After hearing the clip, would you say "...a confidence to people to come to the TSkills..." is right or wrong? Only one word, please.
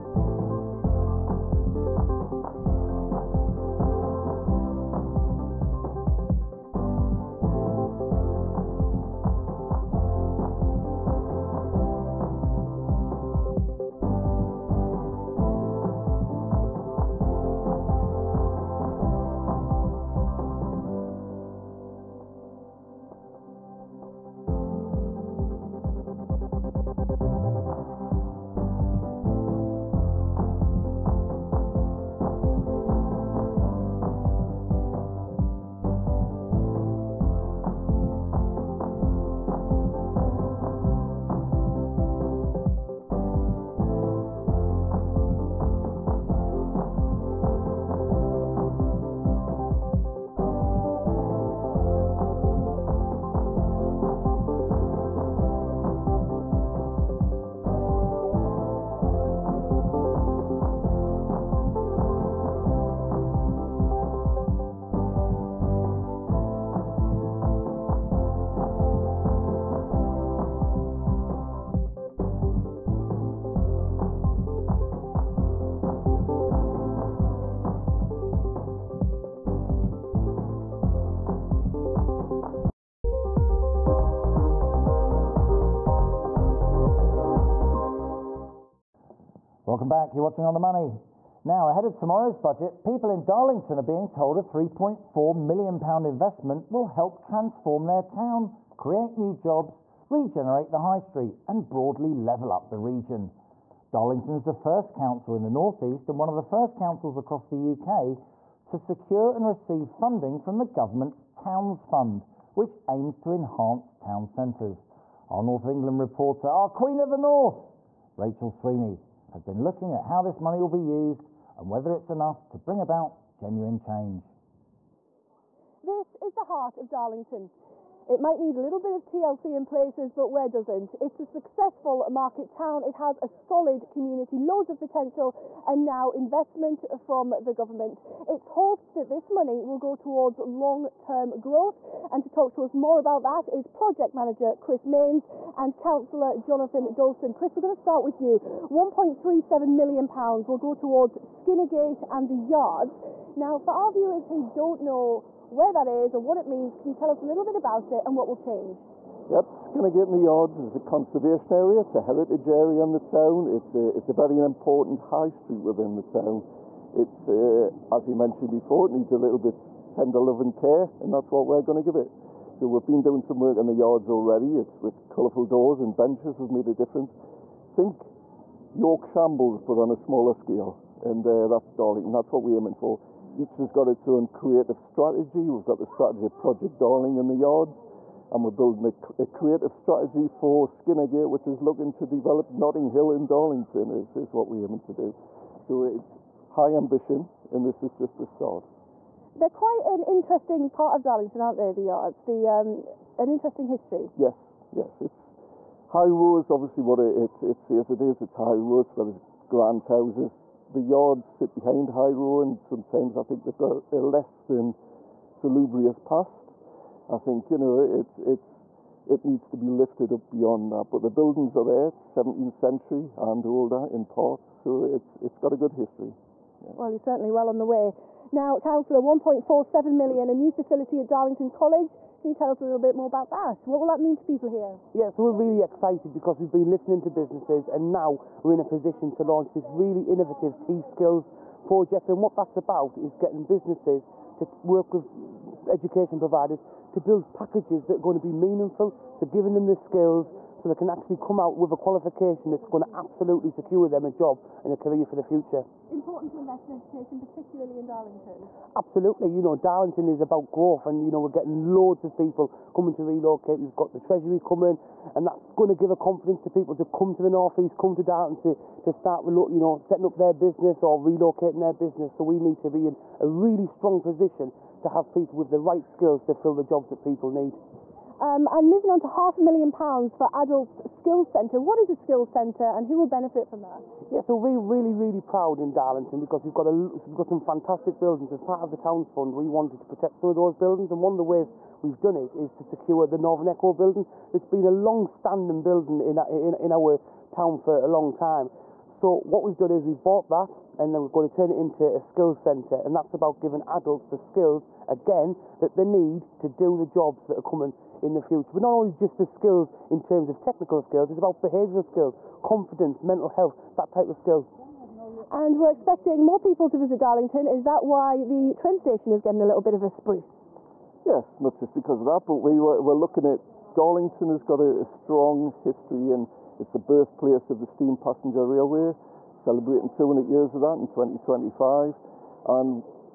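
wrong.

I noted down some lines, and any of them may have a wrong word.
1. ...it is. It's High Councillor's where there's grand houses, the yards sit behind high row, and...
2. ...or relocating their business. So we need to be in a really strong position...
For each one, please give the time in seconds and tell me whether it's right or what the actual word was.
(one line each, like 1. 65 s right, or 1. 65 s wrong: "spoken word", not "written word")
1. 207 s wrong: "Row", not "Councillor"
2. 270 s right.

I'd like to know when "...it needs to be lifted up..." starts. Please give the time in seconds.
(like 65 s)
219 s.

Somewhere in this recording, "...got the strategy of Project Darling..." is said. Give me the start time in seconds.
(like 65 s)
185 s.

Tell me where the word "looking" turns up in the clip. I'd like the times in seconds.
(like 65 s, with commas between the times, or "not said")
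119 s, 191 s, 322 s.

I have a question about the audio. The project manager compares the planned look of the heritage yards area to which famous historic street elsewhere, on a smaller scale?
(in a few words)
York Shambles.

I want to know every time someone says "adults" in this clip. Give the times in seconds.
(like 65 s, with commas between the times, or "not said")
280 s, 303 s.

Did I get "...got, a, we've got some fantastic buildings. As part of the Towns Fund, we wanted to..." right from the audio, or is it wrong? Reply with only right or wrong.
right.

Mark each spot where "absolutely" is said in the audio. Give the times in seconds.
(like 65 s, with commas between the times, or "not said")
252 s, 258 s.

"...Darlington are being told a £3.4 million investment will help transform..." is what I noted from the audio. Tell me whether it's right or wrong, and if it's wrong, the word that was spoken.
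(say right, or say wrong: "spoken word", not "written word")
right.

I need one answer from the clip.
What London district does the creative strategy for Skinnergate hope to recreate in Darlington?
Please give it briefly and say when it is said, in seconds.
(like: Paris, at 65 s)
Notting Hill, at 192 s.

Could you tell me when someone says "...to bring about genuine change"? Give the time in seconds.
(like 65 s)
122 s.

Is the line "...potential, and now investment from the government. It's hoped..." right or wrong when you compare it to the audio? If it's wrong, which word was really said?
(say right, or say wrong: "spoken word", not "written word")
right.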